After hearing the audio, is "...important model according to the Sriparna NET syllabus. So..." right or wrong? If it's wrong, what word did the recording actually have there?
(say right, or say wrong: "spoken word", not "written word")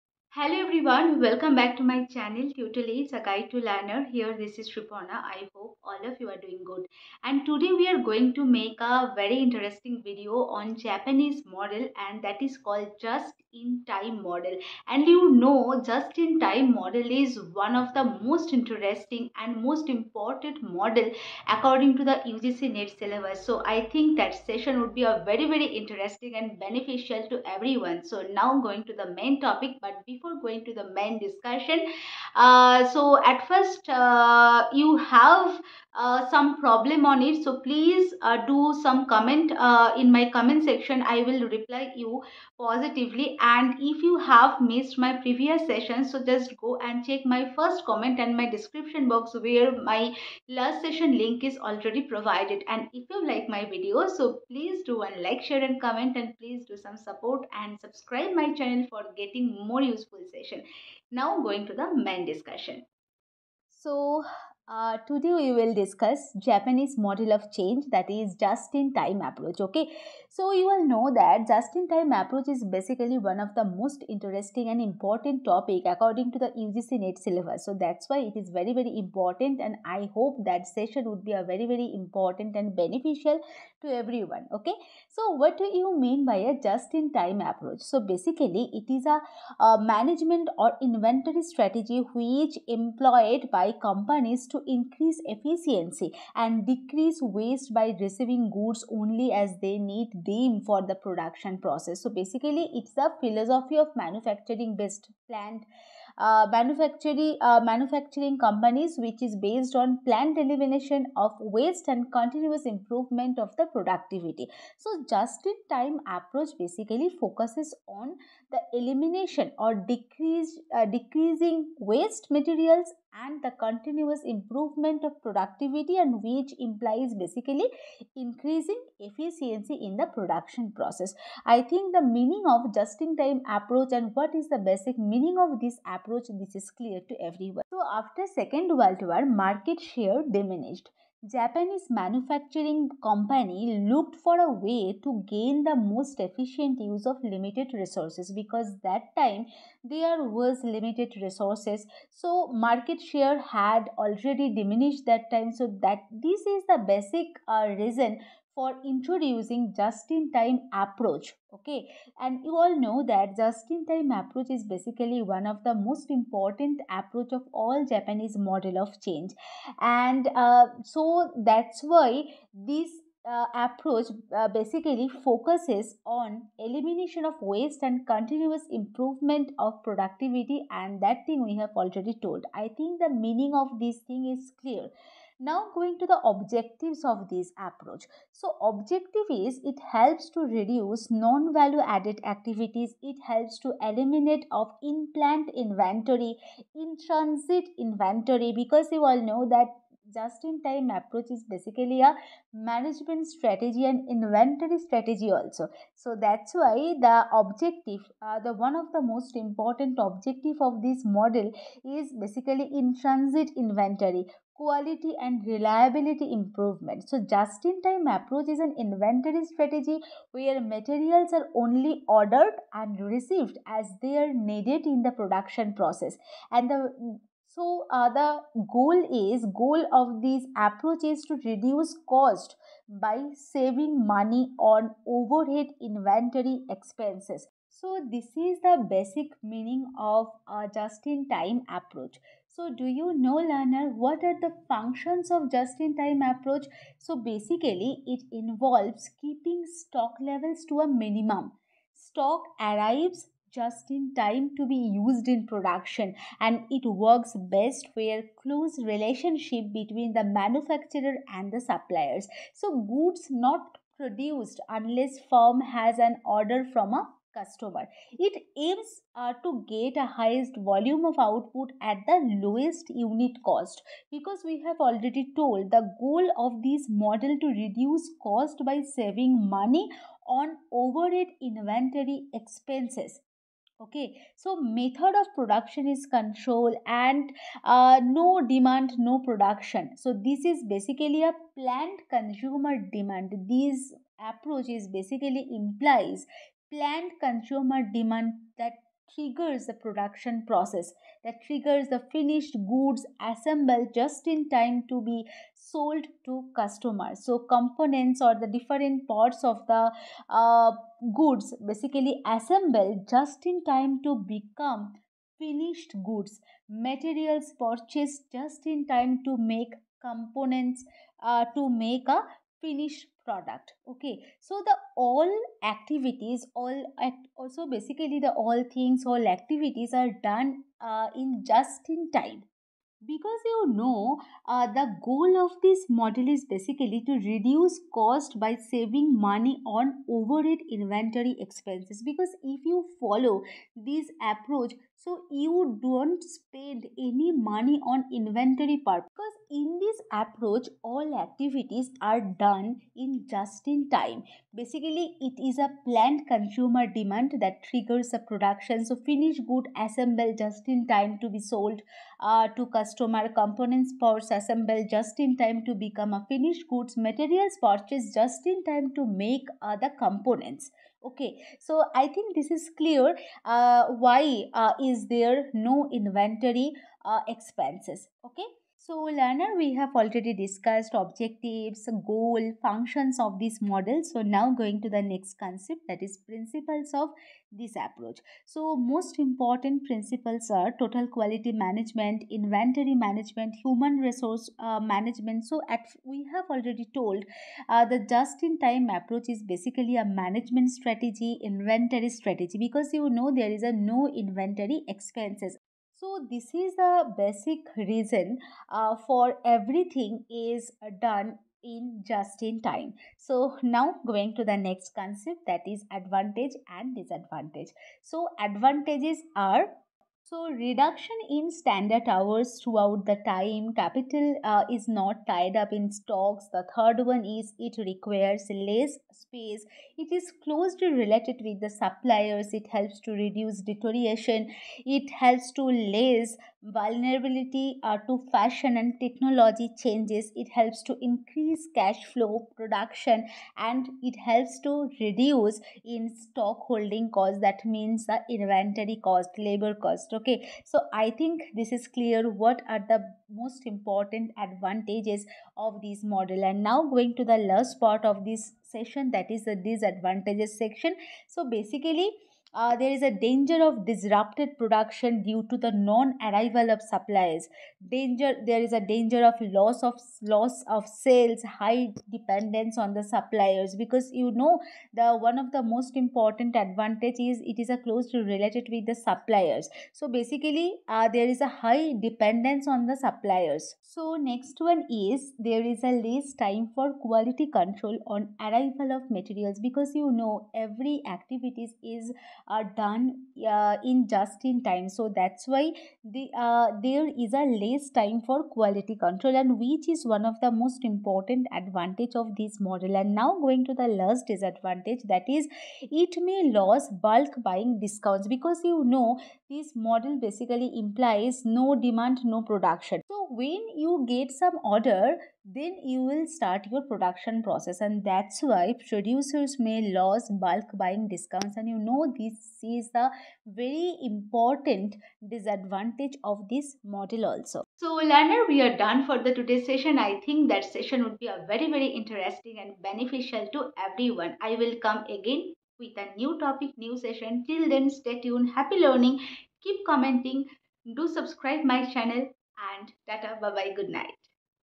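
wrong: "UGC", not "Sriparna".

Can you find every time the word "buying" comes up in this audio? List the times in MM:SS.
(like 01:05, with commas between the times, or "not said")
08:27, 08:40.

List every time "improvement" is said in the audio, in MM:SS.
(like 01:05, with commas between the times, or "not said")
01:52, 02:04, 02:58, 03:36.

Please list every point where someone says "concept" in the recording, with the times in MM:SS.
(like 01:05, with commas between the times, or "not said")
06:25, 06:54.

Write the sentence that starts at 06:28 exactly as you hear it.
So, most important principles are total quality management, inventory management, human resource uh, management.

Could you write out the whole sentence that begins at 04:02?
So do you know learner what are the functions of just-in-time approach?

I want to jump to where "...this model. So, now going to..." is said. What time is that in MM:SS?
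06:23.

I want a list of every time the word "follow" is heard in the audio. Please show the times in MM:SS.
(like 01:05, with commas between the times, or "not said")
05:42.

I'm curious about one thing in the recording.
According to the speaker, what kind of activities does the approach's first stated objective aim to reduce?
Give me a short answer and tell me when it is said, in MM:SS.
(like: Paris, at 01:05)
Non-value added activities, at 03:11.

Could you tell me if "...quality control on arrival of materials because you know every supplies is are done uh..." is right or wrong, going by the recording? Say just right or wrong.
wrong.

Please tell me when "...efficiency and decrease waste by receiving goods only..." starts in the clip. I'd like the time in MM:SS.
01:35.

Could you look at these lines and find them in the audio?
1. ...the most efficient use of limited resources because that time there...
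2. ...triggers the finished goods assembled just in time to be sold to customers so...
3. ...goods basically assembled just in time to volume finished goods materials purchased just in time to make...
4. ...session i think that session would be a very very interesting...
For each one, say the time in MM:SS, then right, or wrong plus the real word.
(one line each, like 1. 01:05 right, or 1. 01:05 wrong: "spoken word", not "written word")
1. 02:25 right
2. 05:01 right
3. 05:11 wrong: "become", not "volume"
4. 08:49 right.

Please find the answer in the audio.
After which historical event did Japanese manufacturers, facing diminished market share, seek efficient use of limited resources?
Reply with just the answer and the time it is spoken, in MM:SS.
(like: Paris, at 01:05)
Second World War, at 02:18.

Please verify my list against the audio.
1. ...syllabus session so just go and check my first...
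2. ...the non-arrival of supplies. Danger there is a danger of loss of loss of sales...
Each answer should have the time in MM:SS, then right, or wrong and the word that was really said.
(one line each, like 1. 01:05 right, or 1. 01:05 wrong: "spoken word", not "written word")
1. 00:45 wrong: "previous", not "syllabus"
2. 07:45 right.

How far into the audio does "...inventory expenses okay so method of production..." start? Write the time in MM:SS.
04:41.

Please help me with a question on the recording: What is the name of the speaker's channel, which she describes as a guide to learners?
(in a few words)
Tutelage.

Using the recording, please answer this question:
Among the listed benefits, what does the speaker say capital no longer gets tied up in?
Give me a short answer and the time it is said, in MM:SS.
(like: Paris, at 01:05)
Stocks, at 07:05.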